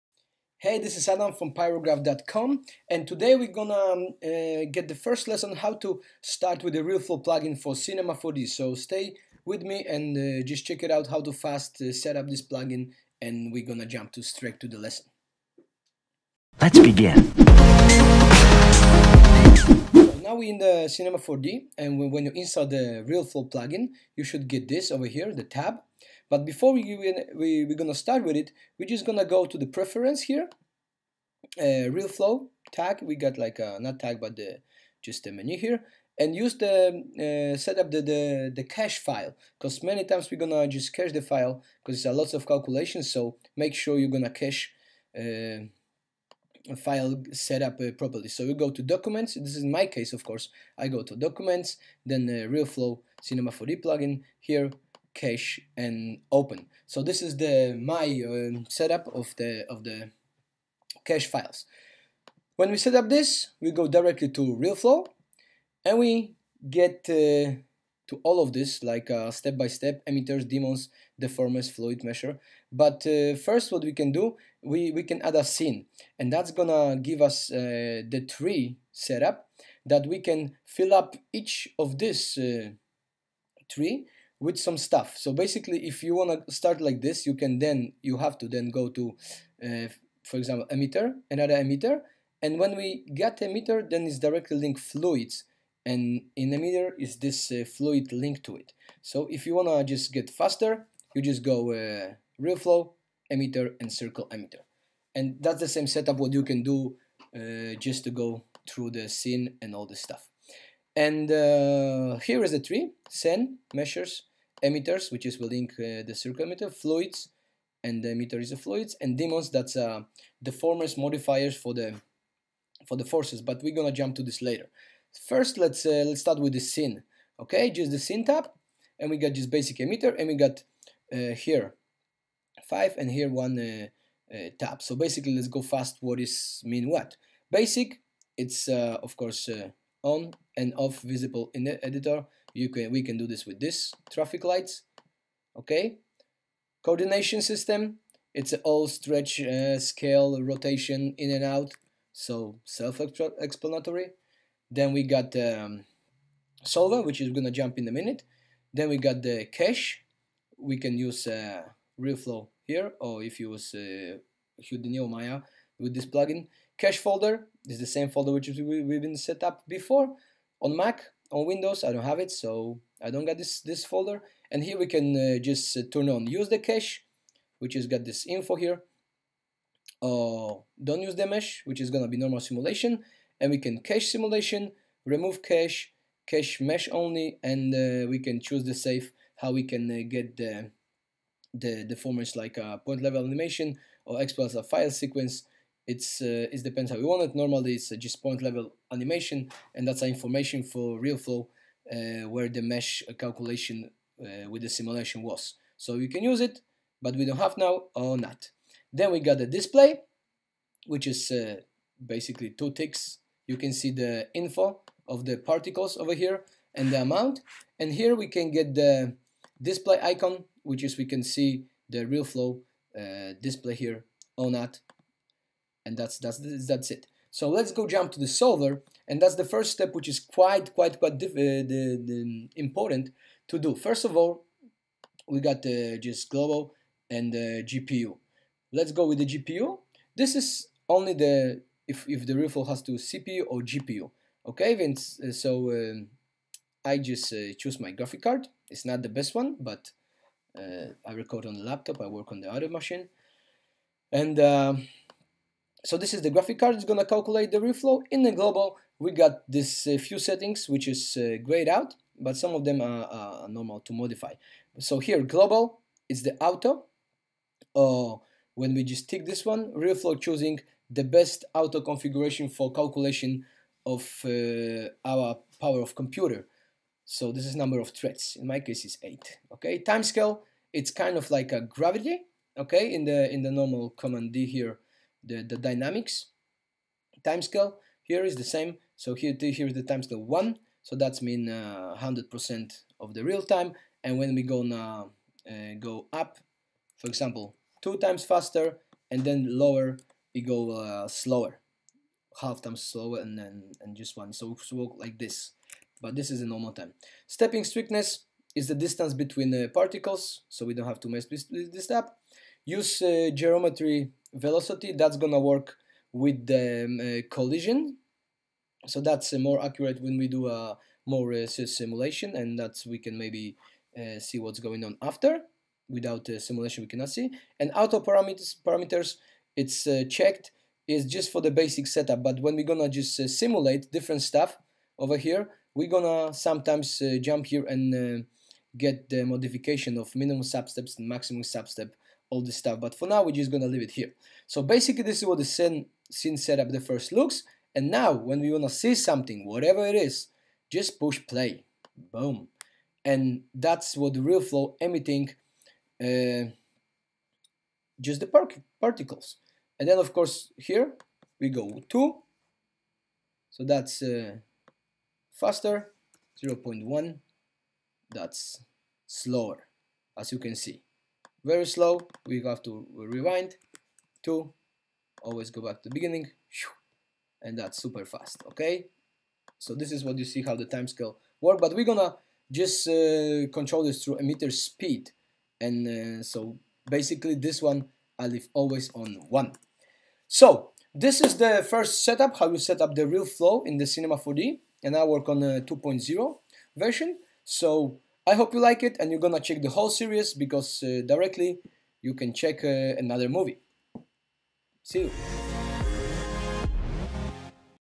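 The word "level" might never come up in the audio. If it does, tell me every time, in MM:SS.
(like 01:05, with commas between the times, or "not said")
03:13, 03:18.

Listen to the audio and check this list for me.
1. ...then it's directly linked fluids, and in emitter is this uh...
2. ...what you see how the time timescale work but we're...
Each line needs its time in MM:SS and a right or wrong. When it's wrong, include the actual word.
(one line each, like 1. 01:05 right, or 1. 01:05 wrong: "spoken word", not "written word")
1. 01:33 right
2. 06:20 wrong: "scale", not "timescale".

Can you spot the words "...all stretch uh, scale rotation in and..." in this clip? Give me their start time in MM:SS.
02:28.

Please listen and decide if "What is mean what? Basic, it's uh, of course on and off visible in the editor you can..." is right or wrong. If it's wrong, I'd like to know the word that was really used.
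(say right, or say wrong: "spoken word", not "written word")
right.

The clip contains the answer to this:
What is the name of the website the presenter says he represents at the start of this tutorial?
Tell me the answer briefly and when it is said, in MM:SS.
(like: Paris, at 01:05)
pirograf.com, at 00:01.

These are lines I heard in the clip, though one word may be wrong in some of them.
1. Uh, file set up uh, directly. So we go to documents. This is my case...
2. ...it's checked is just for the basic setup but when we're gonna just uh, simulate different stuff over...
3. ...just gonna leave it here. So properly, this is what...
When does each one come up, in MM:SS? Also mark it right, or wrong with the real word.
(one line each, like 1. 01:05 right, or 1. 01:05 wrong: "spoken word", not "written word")
1. 00:45 wrong: "properly", not "directly"
2. 05:29 right
3. 05:43 wrong: "basically", not "properly".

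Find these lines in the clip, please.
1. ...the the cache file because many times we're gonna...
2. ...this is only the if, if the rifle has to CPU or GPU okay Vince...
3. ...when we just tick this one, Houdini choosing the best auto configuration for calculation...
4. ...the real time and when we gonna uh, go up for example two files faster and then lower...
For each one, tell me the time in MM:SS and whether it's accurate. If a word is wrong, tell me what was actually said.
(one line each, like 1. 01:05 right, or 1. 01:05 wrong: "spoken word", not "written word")
1. 00:38 right
2. 04:00 right
3. 04:28 wrong: "RealFlow", not "Houdini"
4. 04:53 wrong: "times", not "files".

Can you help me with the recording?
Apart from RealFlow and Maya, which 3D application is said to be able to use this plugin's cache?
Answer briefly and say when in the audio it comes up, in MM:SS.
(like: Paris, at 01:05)
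Houdini, at 02:44.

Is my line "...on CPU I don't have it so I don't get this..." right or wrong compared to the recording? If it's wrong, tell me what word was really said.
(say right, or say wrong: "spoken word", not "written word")
wrong: "Windows", not "CPU".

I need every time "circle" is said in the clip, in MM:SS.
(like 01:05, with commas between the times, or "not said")
01:43, 01:56.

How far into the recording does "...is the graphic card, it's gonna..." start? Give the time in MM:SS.
04:16.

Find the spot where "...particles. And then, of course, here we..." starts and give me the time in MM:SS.
05:58.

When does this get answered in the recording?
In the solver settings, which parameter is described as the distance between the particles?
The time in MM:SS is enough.
05:07.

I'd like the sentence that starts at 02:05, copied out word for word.
First, let's uh, let's start with the scene, okay?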